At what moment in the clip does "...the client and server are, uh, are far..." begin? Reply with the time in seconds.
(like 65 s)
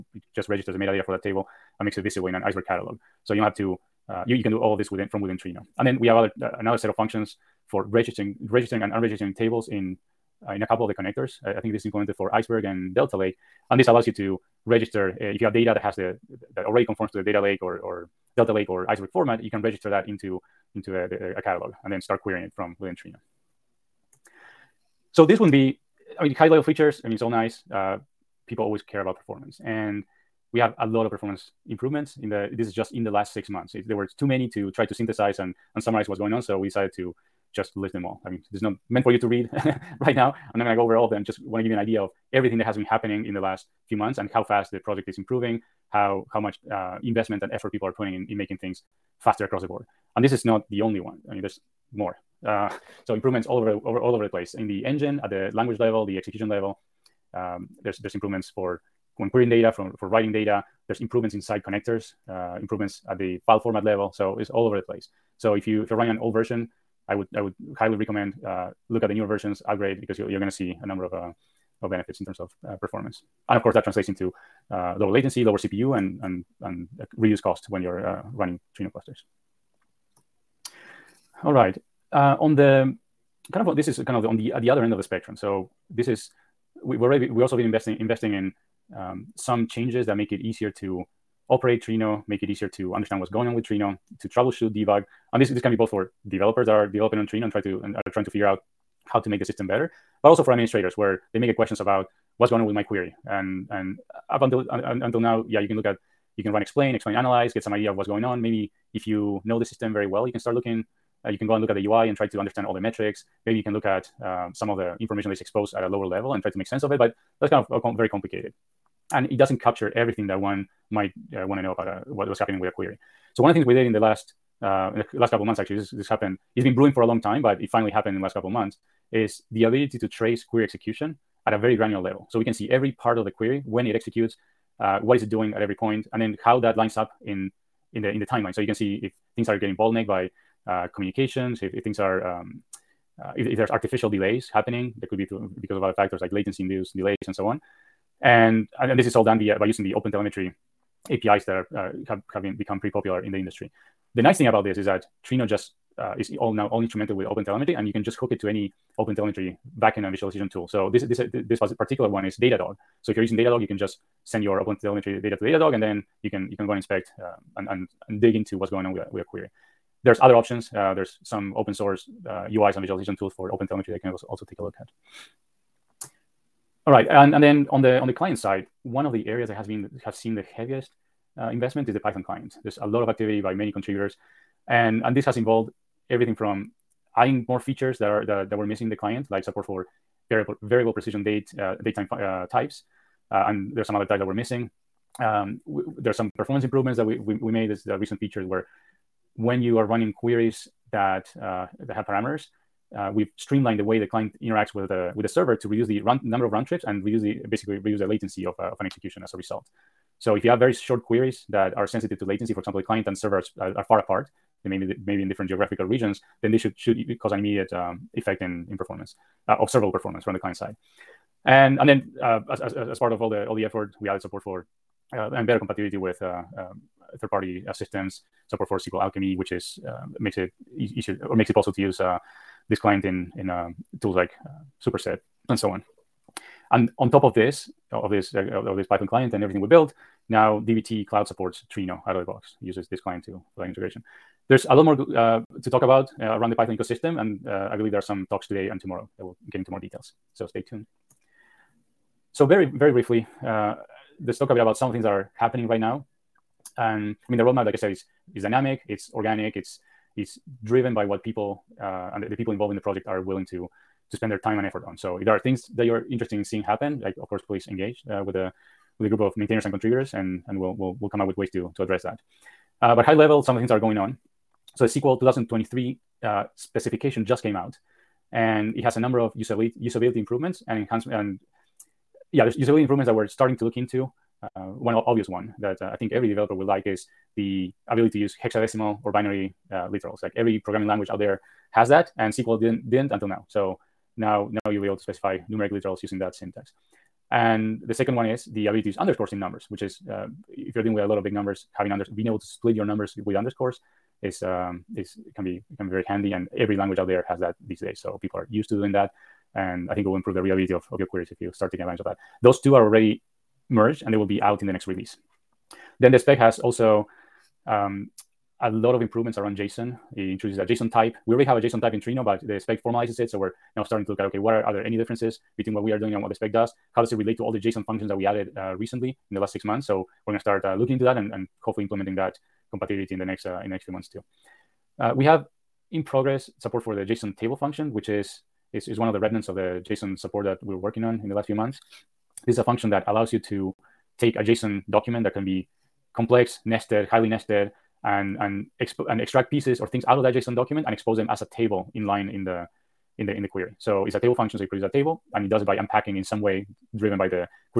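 212 s.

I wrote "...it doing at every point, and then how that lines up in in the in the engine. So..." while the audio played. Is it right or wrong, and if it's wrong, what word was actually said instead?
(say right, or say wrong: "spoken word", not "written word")
wrong: "timeline", not "engine".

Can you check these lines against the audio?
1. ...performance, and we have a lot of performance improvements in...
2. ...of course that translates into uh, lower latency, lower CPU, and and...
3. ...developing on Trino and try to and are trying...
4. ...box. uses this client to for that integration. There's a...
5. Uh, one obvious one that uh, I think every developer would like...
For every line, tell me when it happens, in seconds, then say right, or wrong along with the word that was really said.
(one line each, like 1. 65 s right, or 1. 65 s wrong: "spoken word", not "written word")
1. 29 s right
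2. 73 s right
3. 96 s right
4. 242 s right
5. 284 s right.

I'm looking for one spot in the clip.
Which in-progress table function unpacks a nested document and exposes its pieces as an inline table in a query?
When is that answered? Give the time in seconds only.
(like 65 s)
337 s.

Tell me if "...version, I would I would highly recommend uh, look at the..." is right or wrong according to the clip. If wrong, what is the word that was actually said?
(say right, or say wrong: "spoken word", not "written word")
right.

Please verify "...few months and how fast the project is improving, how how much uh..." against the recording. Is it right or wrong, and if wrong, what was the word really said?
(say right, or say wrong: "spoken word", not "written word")
right.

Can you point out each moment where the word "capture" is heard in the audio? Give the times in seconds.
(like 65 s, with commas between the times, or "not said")
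119 s.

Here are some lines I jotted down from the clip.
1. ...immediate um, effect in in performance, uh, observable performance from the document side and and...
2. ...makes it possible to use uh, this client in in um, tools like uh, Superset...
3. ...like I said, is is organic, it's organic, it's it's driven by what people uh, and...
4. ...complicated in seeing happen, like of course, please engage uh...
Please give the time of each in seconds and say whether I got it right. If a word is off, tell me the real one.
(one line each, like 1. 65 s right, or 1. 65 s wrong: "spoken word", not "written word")
1. 217 s wrong: "client", not "document"
2. 231 s right
3. 257 s wrong: "dynamic", not "organic"
4. 266 s wrong: "interested", not "complicated".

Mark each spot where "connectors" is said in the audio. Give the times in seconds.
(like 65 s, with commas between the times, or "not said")
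10 s, 61 s.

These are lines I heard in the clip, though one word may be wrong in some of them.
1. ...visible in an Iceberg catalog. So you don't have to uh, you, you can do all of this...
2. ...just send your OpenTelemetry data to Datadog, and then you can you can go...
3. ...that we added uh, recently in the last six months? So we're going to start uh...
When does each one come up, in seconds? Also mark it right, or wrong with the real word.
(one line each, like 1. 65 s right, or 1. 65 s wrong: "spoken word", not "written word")
1. 2 s right
2. 163 s right
3. 328 s right.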